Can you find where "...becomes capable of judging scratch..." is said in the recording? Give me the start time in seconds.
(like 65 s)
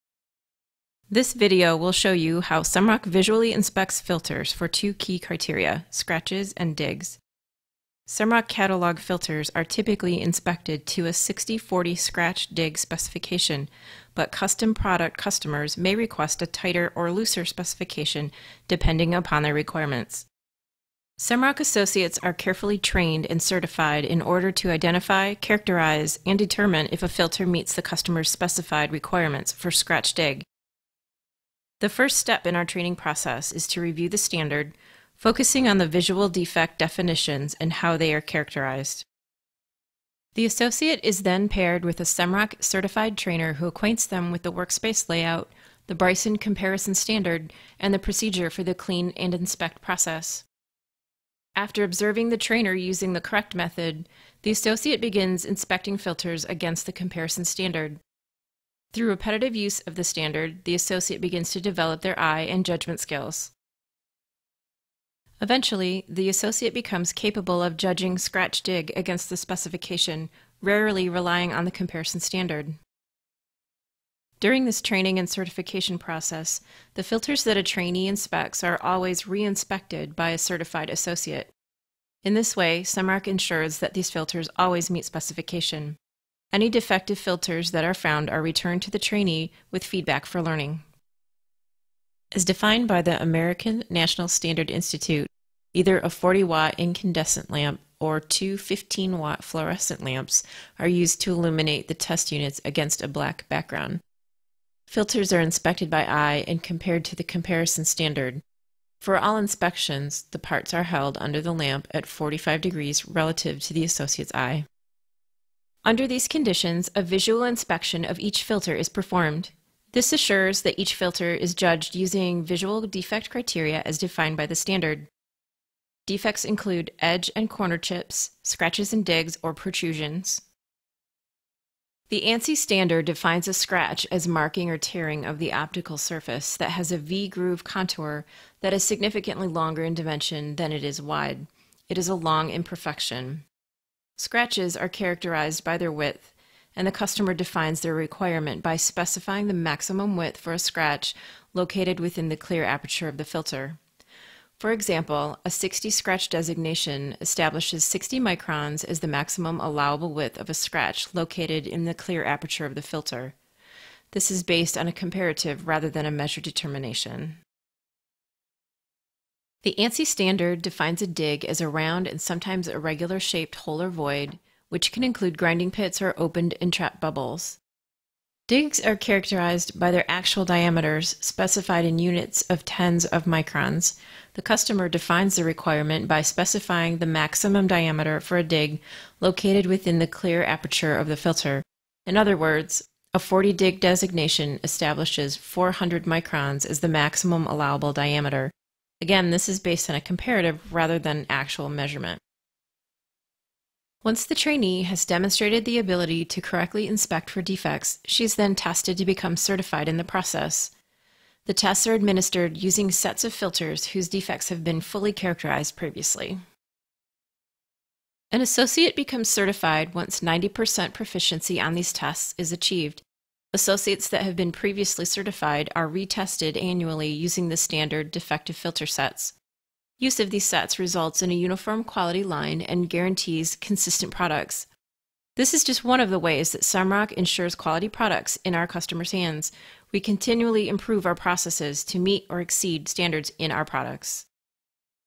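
66 s.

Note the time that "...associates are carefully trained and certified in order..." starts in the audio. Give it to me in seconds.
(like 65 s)
21 s.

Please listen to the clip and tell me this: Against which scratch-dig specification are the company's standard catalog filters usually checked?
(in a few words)
60-40.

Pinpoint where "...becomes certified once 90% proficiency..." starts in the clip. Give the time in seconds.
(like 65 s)
218 s.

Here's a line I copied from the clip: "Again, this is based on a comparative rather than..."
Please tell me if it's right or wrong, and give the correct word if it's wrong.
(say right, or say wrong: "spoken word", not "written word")
right.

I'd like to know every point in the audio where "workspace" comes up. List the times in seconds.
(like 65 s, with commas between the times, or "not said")
44 s.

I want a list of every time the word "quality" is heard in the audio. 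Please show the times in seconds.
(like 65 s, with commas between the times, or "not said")
231 s, 237 s.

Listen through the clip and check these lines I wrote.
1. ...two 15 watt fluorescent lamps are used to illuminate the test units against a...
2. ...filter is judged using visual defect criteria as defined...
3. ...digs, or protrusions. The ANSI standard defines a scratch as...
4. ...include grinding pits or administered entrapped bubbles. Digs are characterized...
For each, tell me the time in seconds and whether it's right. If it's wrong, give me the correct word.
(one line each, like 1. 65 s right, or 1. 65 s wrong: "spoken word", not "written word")
1. 98 s right
2. 120 s right
3. 129 s right
4. 175 s wrong: "opened", not "administered".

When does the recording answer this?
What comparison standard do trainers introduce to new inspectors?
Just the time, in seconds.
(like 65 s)
45 s.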